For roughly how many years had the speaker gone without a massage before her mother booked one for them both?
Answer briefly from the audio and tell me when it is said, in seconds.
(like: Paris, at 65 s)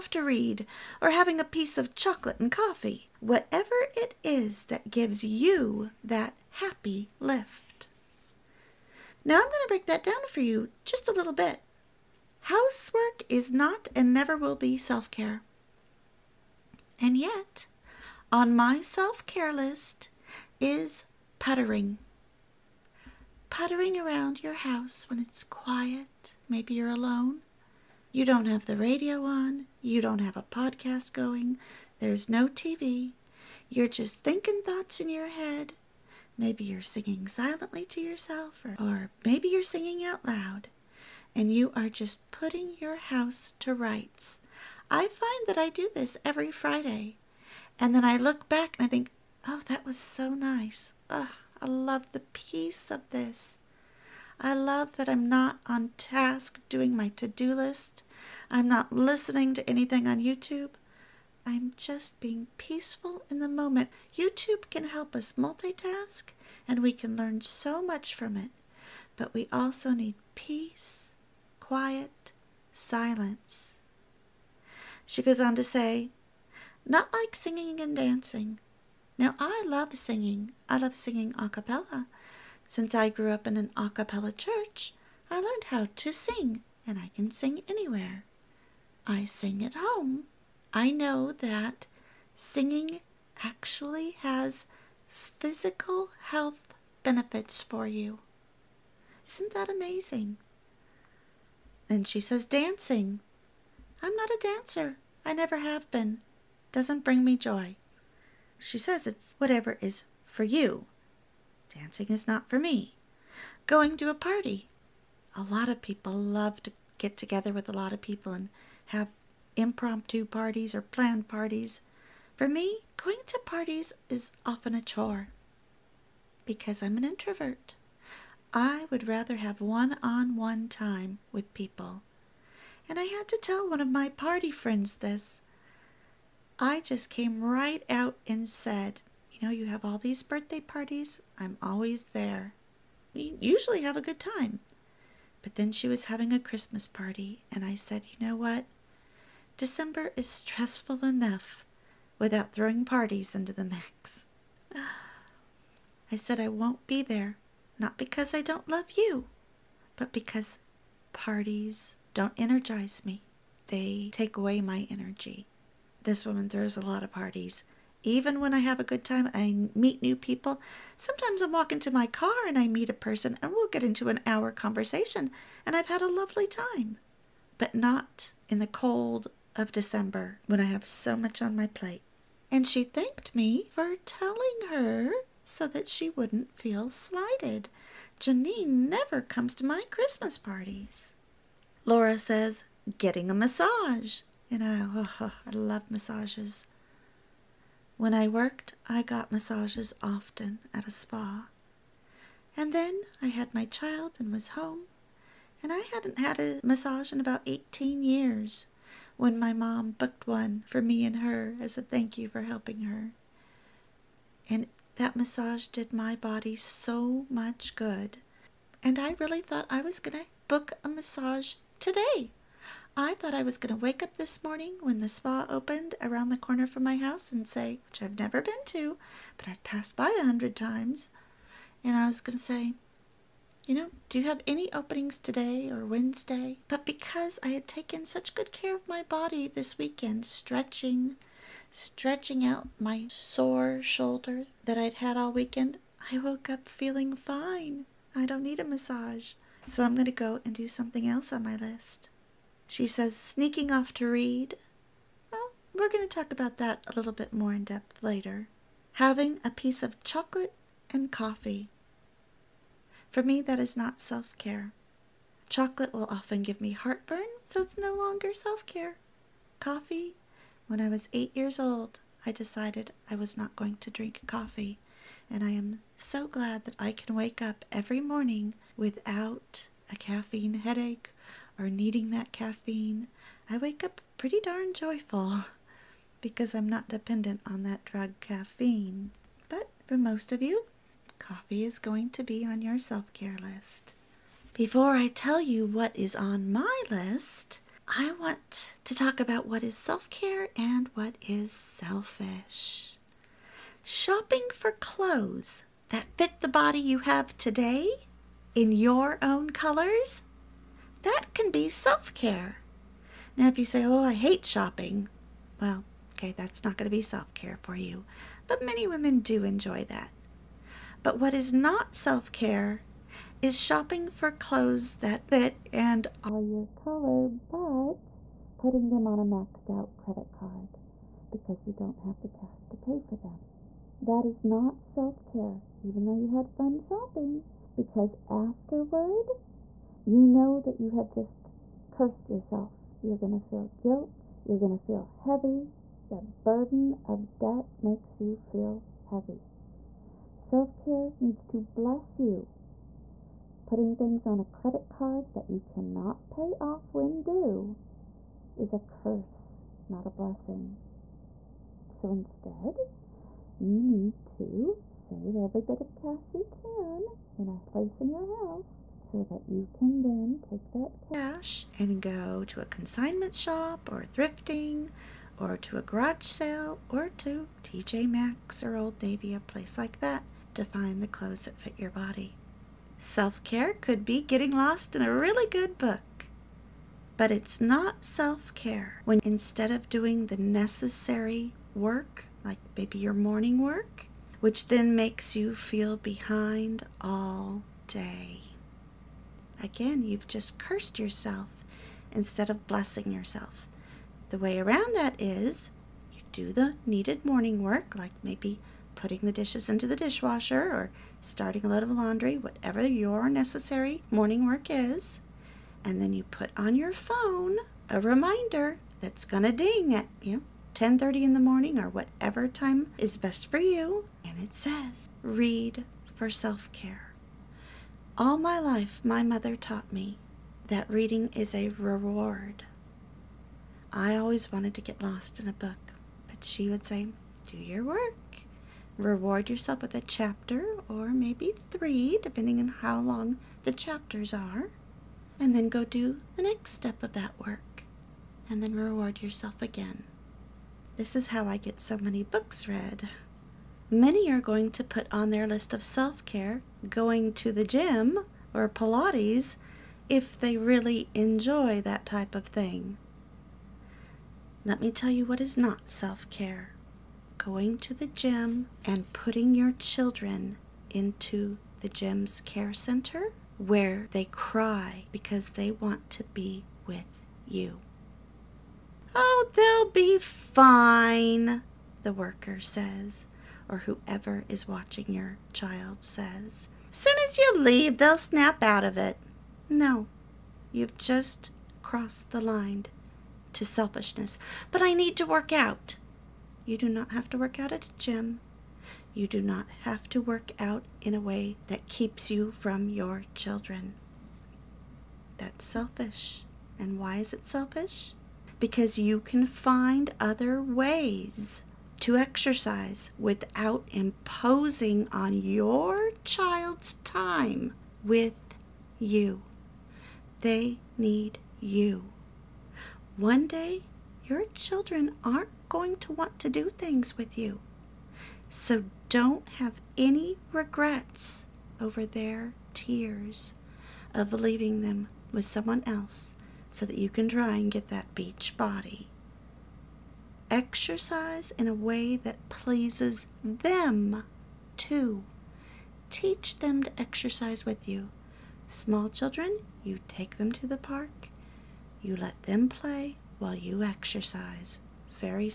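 18 years, at 207 s.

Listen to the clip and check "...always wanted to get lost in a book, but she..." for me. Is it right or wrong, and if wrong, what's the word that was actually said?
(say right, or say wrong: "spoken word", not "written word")
right.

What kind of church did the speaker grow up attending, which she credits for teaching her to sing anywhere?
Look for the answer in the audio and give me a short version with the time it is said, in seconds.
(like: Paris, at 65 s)
A cappella church, at 83 s.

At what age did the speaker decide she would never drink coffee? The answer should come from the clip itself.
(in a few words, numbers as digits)
8.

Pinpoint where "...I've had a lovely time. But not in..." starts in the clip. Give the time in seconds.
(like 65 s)
175 s.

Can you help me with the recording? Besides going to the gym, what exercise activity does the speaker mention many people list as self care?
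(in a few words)
Pilates.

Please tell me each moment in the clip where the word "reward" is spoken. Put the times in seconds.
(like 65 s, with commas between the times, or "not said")
431 s, 439 s, 448 s.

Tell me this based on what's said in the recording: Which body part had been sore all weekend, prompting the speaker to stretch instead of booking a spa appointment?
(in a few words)
Shoulder.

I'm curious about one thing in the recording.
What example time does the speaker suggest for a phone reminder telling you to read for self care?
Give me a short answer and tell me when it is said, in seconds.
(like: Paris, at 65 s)
10:30, at 420 s.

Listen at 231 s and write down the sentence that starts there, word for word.
And I was going to say, you know, do you have any openings today or Wednesday?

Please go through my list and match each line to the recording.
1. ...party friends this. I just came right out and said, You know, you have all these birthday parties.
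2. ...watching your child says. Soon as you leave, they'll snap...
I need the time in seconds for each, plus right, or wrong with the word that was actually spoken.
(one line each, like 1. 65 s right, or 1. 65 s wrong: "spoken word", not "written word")
1. 134 s right
2. 484 s right.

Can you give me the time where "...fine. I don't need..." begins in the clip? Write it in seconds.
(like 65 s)
247 s.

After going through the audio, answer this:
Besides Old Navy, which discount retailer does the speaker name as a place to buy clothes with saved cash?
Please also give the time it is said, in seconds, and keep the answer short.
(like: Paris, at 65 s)
TJ Maxx, at 377 s.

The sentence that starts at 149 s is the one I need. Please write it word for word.
December is stressful enough without throwing parties into the mix.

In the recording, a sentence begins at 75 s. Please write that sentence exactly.
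She goes on to say, Not like singing and dancing.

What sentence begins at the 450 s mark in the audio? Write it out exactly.
This is how I get so many books read.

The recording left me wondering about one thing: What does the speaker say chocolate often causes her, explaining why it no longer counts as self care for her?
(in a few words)
Heartburn.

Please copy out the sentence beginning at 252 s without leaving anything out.
She says, sneaking off to read.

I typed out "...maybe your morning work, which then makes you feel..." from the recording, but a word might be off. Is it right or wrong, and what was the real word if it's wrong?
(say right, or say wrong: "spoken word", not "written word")
right.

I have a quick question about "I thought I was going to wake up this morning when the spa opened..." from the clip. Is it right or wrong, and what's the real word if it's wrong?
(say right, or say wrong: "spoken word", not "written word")
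right.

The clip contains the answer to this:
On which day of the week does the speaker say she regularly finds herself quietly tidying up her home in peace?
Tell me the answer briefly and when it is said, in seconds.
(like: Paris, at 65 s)
Friday, at 46 s.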